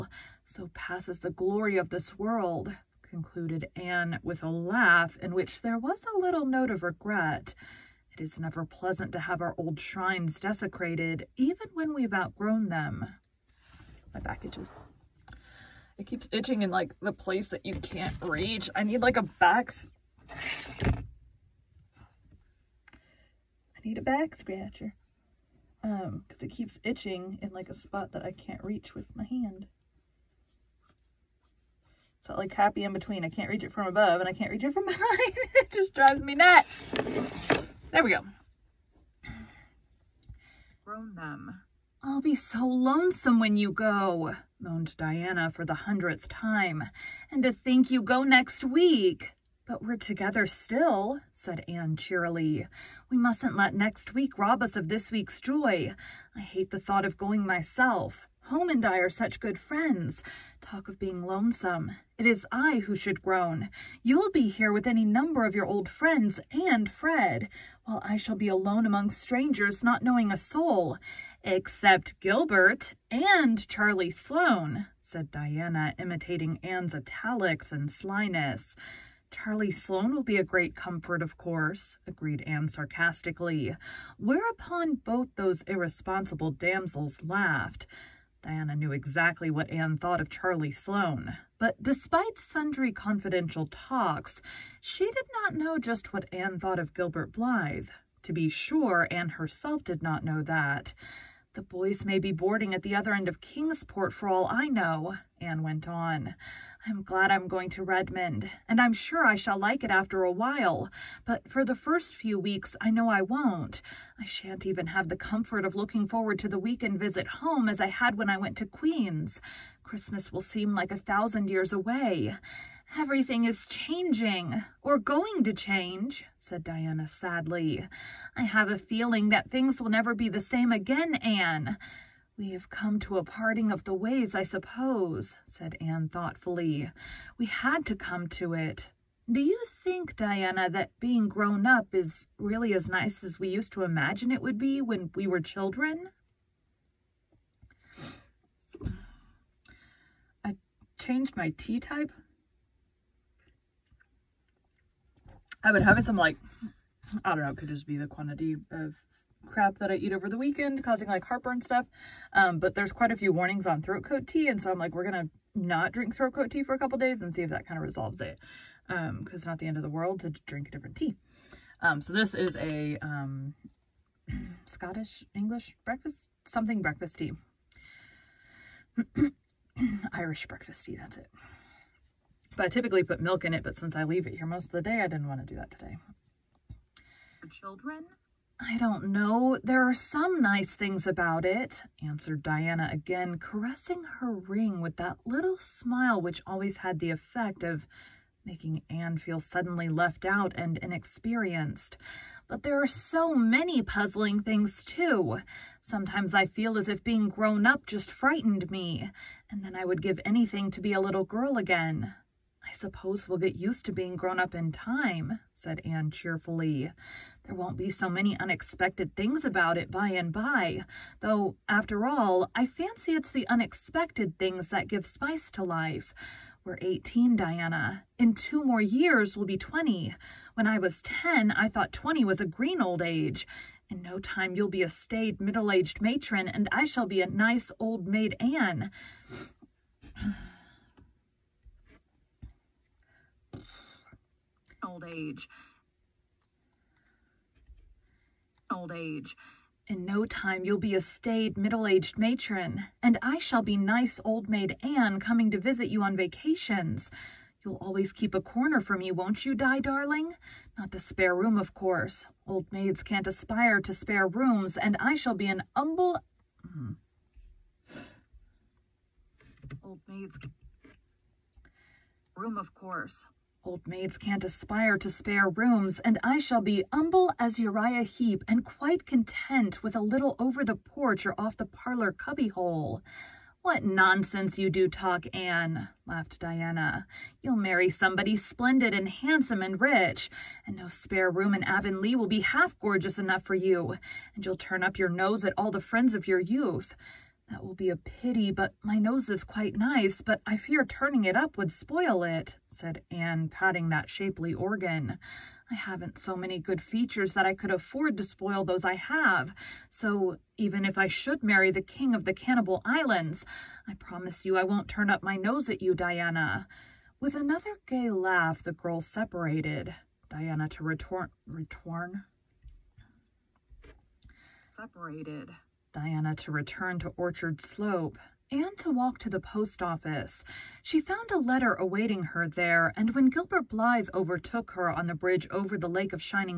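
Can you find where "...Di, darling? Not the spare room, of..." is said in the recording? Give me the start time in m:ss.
4:19.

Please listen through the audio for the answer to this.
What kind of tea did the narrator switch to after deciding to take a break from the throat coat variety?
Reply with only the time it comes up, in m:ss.
3:00.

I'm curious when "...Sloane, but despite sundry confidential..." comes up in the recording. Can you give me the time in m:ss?
1:30.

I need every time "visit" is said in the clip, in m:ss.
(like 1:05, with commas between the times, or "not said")
1:56, 4:15.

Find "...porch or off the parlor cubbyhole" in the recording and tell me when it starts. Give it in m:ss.
4:40.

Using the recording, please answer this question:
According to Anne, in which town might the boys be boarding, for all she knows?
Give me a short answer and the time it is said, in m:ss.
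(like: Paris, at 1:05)
Kingsport, at 1:43.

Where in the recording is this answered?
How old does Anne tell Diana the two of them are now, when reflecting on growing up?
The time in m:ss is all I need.
3:46.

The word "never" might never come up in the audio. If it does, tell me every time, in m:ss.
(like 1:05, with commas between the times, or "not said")
0:08, 2:09.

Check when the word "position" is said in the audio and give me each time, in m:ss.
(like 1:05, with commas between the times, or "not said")
not said.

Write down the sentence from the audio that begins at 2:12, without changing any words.
We have come to a parting of the ways, I suppose, said Anne thoughtfully.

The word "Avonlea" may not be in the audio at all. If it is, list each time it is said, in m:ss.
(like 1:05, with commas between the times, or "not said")
4:51.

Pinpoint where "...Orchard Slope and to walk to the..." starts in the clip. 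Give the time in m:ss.
5:27.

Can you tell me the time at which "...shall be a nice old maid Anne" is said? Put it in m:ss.
3:56.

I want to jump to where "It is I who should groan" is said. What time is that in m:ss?
1:02.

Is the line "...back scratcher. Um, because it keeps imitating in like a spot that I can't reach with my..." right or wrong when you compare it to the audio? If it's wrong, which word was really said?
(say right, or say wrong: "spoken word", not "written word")
wrong: "itching", not "imitating".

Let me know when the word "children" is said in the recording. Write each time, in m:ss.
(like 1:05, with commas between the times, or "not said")
2:25, 3:07.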